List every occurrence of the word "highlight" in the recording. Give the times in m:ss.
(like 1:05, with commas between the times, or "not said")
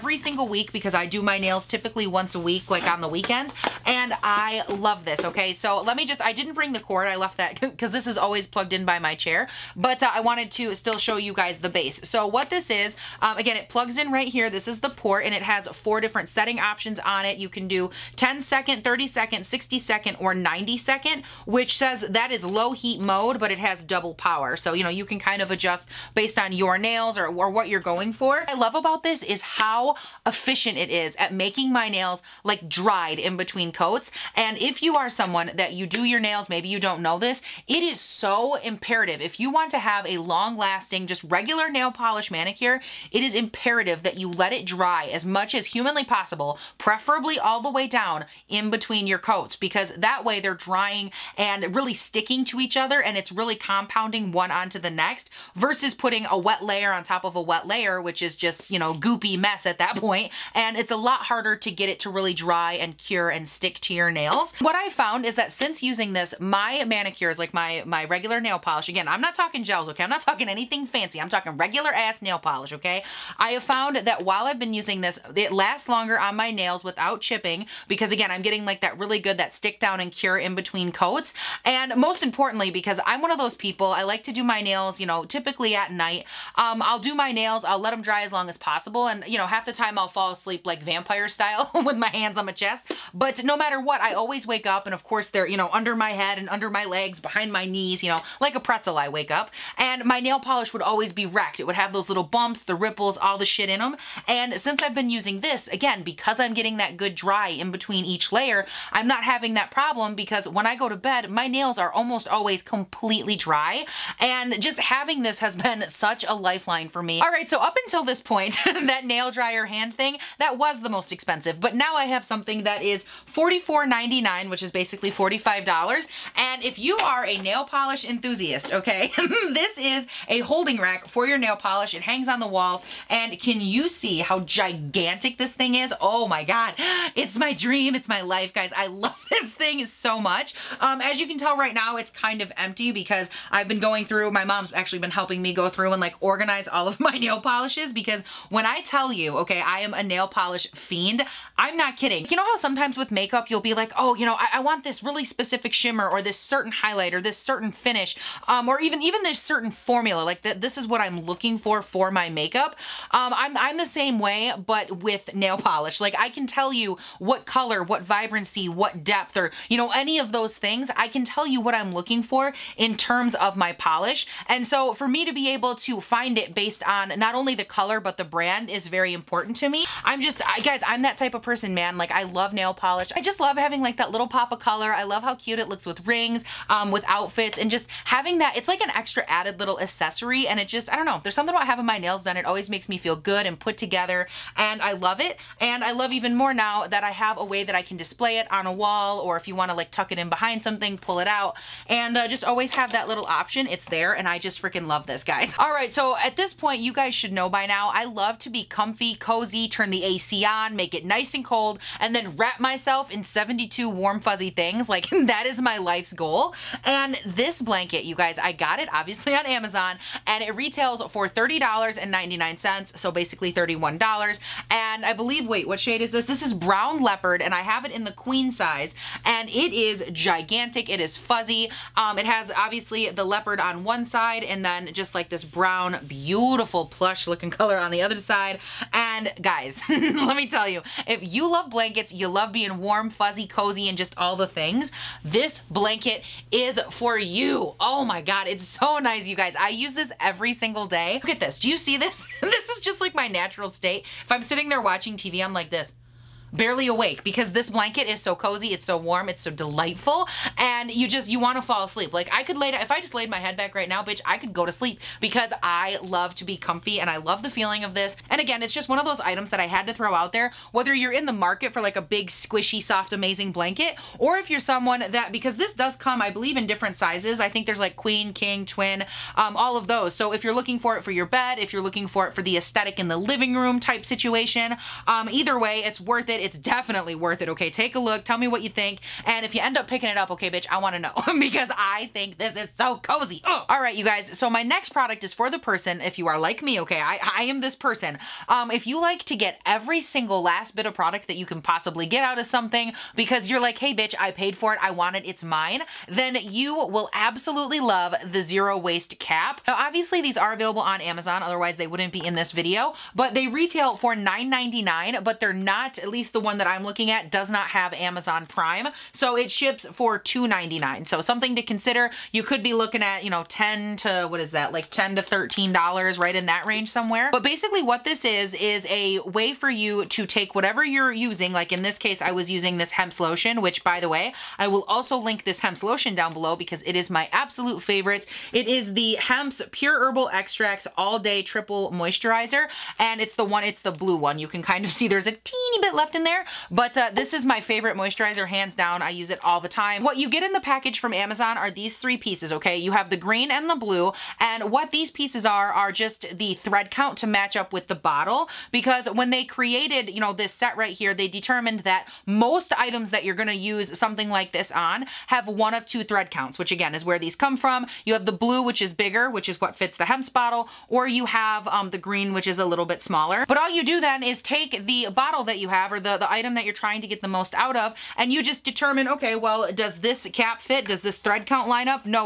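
2:36.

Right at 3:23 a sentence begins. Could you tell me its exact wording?
It's there and I just freaking love this, guys.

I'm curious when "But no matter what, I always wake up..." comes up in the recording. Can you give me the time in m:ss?
1:33.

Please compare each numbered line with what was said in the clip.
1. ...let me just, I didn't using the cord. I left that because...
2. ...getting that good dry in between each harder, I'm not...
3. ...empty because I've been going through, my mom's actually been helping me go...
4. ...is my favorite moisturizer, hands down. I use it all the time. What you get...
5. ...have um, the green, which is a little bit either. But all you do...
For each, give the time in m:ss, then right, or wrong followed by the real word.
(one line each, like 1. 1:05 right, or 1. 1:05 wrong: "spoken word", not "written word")
1. 0:05 wrong: "bring", not "using"
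2. 1:46 wrong: "layer", not "harder"
3. 2:22 right
4. 5:47 right
5. 6:11 wrong: "smaller", not "either".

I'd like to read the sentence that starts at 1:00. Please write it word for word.
And it's a lot harder to get it to really dry and cure and stick to your nails.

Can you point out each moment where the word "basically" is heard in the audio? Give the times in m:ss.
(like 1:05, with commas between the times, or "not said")
2:04, 3:43, 5:27.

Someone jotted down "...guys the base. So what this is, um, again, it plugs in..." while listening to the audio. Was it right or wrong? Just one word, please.
right.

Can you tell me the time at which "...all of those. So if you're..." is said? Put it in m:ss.
4:39.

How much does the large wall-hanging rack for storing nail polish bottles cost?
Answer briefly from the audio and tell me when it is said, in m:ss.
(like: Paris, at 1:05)
$44.99, at 2:03.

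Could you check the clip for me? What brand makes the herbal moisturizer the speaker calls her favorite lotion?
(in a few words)
Hempz.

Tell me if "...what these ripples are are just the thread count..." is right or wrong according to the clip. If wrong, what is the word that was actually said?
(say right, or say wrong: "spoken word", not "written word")
wrong: "pieces", not "ripples".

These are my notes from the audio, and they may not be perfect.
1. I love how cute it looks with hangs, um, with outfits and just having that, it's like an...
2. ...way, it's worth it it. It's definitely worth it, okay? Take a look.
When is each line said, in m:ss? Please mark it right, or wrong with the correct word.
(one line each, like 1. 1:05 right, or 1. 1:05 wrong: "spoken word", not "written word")
1. 3:04 wrong: "rings", not "hangs"
2. 4:45 right.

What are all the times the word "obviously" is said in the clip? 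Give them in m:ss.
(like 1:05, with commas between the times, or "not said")
3:38, 3:52, 5:09.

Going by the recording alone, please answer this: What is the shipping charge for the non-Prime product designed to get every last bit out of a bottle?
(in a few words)
$2.99.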